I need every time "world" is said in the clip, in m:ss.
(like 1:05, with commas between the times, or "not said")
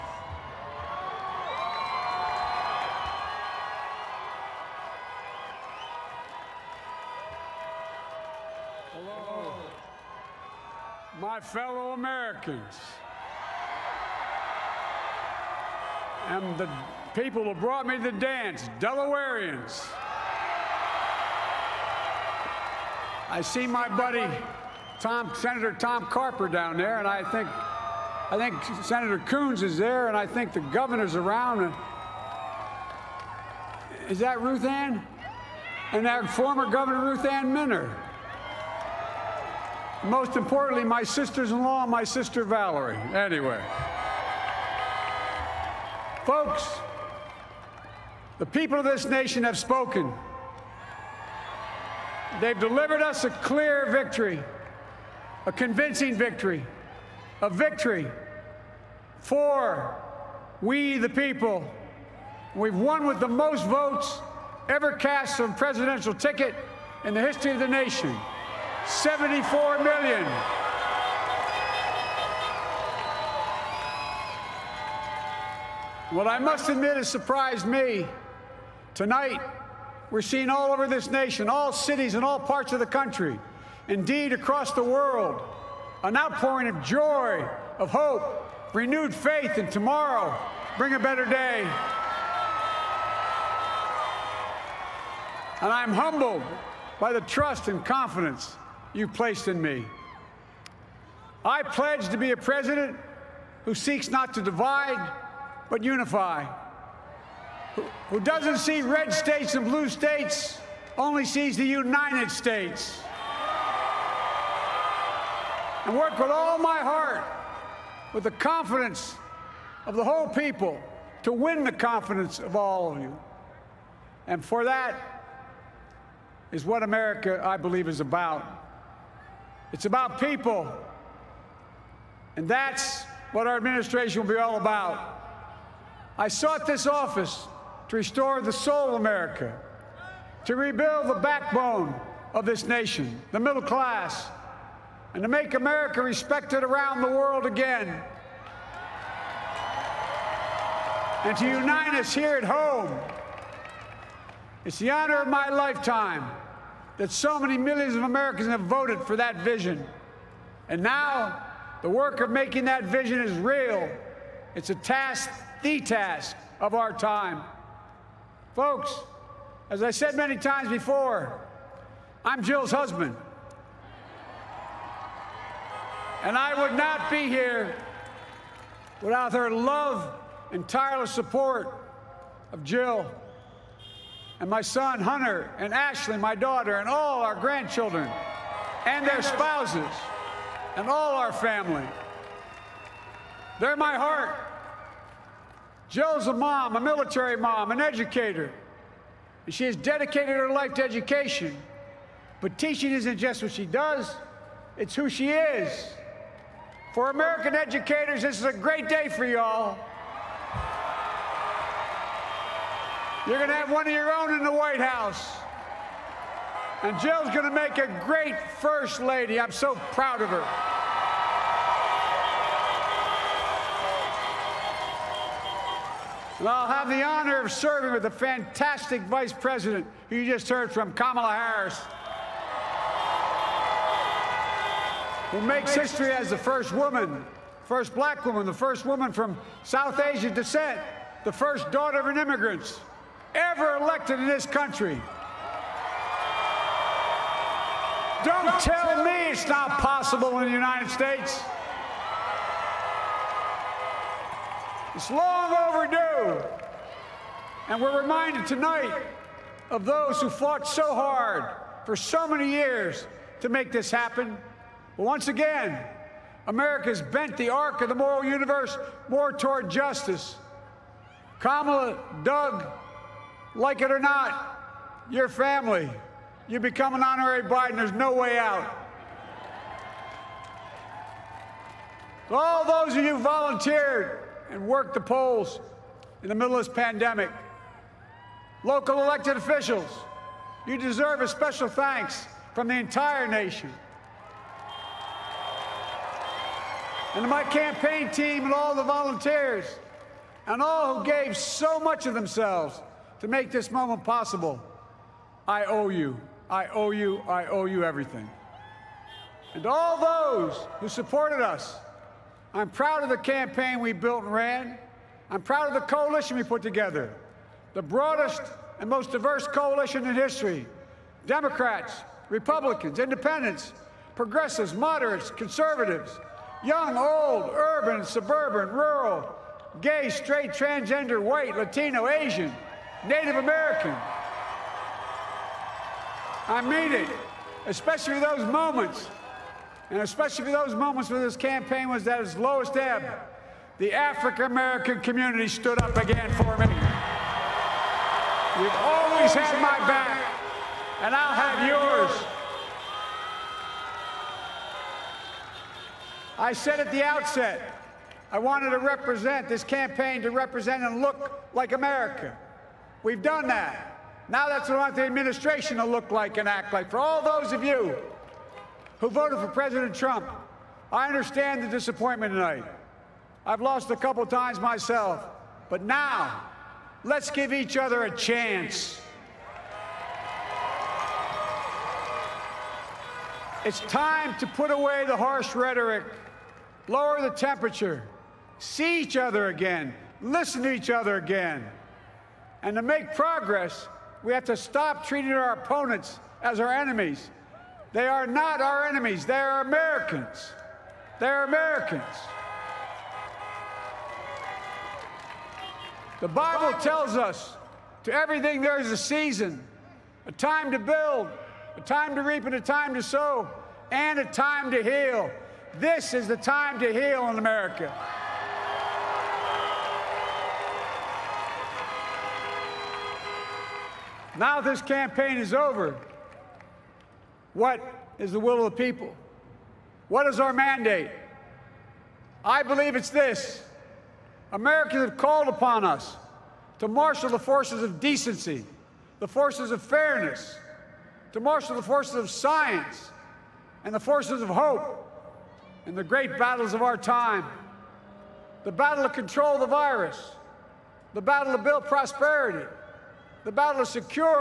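1:24, 2:27.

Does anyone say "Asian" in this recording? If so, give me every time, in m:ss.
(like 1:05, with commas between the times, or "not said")
4:00, 5:32.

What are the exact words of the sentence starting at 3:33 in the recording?
You're going to have one of your own in the White House.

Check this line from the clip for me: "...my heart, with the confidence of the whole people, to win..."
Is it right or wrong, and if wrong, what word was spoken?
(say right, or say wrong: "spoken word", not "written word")
right.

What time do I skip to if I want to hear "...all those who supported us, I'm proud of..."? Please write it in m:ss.
5:09.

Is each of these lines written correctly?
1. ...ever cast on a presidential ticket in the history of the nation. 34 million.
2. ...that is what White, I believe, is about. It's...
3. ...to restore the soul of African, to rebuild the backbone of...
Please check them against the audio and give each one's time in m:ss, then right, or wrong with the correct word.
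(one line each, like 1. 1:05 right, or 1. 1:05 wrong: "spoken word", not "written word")
1. 1:04 wrong: "74", not "34"
2. 2:04 wrong: "America", not "White"
3. 2:17 wrong: "America", not "African".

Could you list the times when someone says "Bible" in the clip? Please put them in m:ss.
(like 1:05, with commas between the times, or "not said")
6:46.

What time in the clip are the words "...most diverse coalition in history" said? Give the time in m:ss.
5:18.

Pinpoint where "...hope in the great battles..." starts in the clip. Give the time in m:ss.
7:24.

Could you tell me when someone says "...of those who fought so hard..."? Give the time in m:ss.
4:19.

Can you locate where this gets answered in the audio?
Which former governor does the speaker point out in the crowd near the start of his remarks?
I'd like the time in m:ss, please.
0:37.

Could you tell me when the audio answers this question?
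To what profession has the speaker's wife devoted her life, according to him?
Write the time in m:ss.
3:20.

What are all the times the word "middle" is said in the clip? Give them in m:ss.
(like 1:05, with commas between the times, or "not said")
2:23, 4:46.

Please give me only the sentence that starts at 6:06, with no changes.
For all those of you who voted for President Trump, I understand the disappointment tonight.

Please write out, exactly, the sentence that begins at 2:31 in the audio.
And to unite us here at home.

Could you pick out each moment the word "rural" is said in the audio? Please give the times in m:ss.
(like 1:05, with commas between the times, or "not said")
5:28.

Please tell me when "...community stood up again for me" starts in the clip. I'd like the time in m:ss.
5:44.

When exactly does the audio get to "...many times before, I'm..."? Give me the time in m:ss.
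2:50.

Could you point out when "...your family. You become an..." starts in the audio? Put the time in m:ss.
4:35.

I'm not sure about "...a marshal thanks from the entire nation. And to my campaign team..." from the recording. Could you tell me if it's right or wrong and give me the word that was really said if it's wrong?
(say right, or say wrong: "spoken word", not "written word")
wrong: "special", not "marshal".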